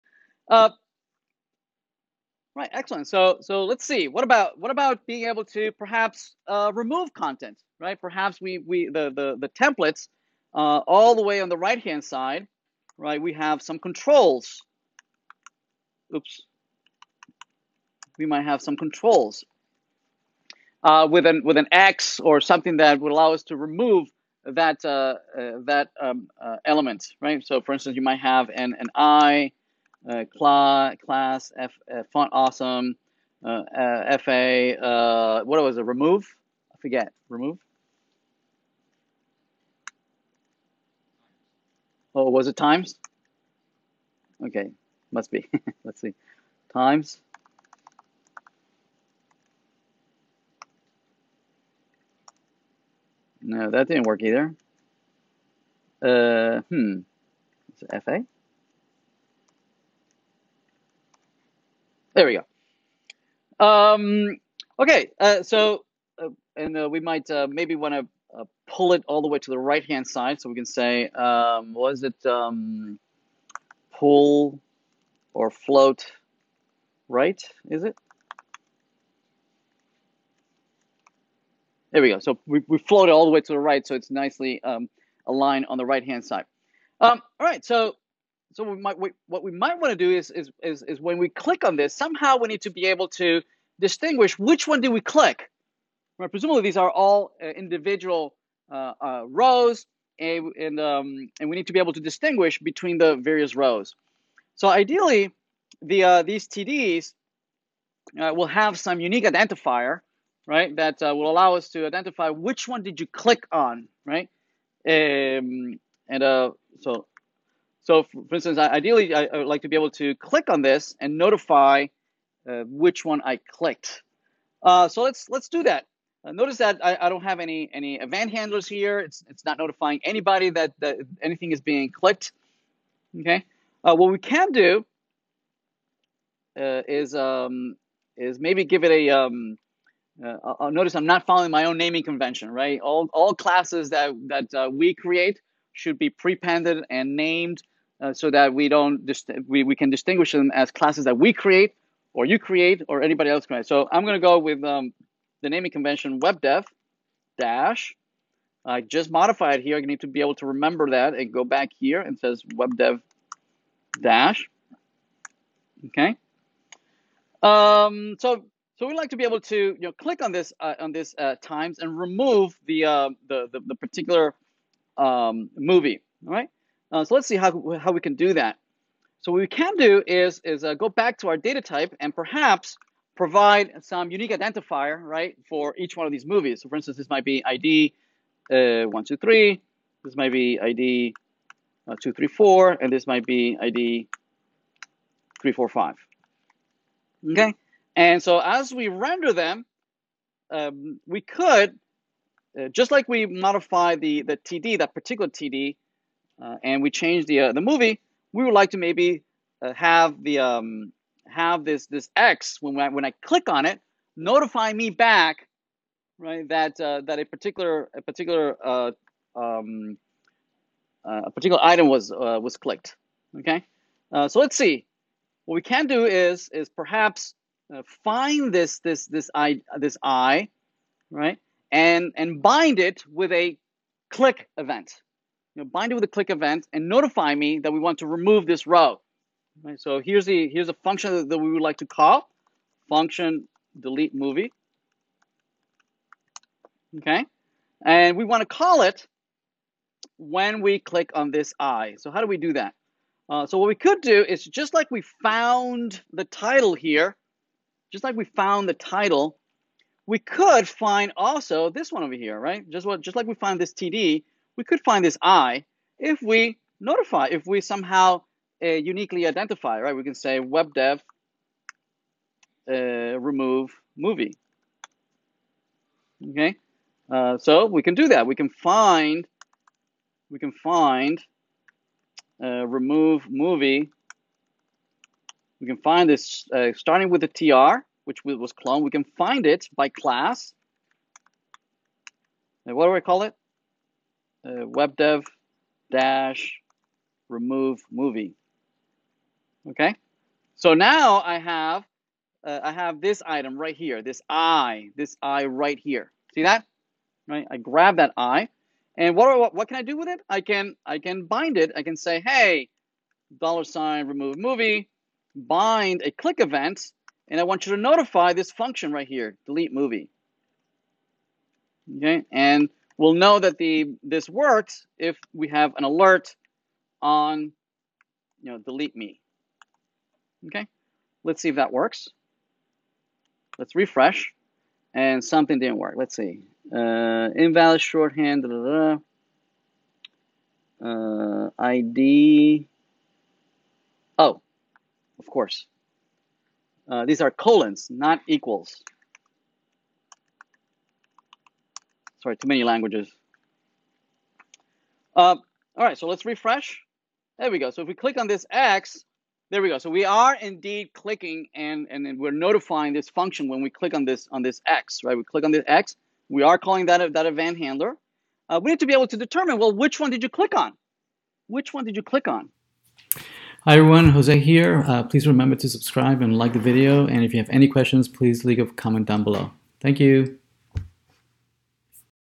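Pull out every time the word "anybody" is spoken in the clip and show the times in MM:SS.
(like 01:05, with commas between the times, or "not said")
02:10, 02:33.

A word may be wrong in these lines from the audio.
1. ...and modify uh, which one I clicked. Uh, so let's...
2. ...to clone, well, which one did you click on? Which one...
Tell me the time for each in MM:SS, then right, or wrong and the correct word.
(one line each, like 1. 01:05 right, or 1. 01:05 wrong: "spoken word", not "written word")
1. 02:00 wrong: "notify", not "modify"
2. 06:09 wrong: "determine", not "clone".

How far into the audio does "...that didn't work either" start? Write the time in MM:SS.
00:53.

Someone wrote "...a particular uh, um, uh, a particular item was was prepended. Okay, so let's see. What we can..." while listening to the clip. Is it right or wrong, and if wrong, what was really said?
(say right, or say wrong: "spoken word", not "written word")
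wrong: "clicked", not "prepended".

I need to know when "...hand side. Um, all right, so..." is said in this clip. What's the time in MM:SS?
01:26.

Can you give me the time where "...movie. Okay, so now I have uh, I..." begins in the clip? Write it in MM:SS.
04:57.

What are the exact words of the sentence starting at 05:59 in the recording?
So we are indeed clicking and, and, we're notifying this function when we click on this on this X, right?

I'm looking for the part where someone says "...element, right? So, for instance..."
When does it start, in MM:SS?
00:26.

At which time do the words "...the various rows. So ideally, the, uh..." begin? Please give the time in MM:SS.
01:42.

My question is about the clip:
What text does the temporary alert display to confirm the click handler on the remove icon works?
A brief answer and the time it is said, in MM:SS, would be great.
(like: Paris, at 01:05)
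delete me, at 05:28.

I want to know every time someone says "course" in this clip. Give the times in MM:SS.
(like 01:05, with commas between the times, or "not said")
05:45.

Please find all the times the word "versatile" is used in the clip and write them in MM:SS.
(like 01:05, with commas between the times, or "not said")
not said.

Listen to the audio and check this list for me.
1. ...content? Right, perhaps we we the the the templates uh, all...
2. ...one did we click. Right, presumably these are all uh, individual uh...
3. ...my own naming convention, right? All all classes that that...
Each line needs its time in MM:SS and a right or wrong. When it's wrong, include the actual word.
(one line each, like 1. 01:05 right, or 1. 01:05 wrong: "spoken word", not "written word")
1. 00:07 right
2. 01:34 right
3. 02:21 right.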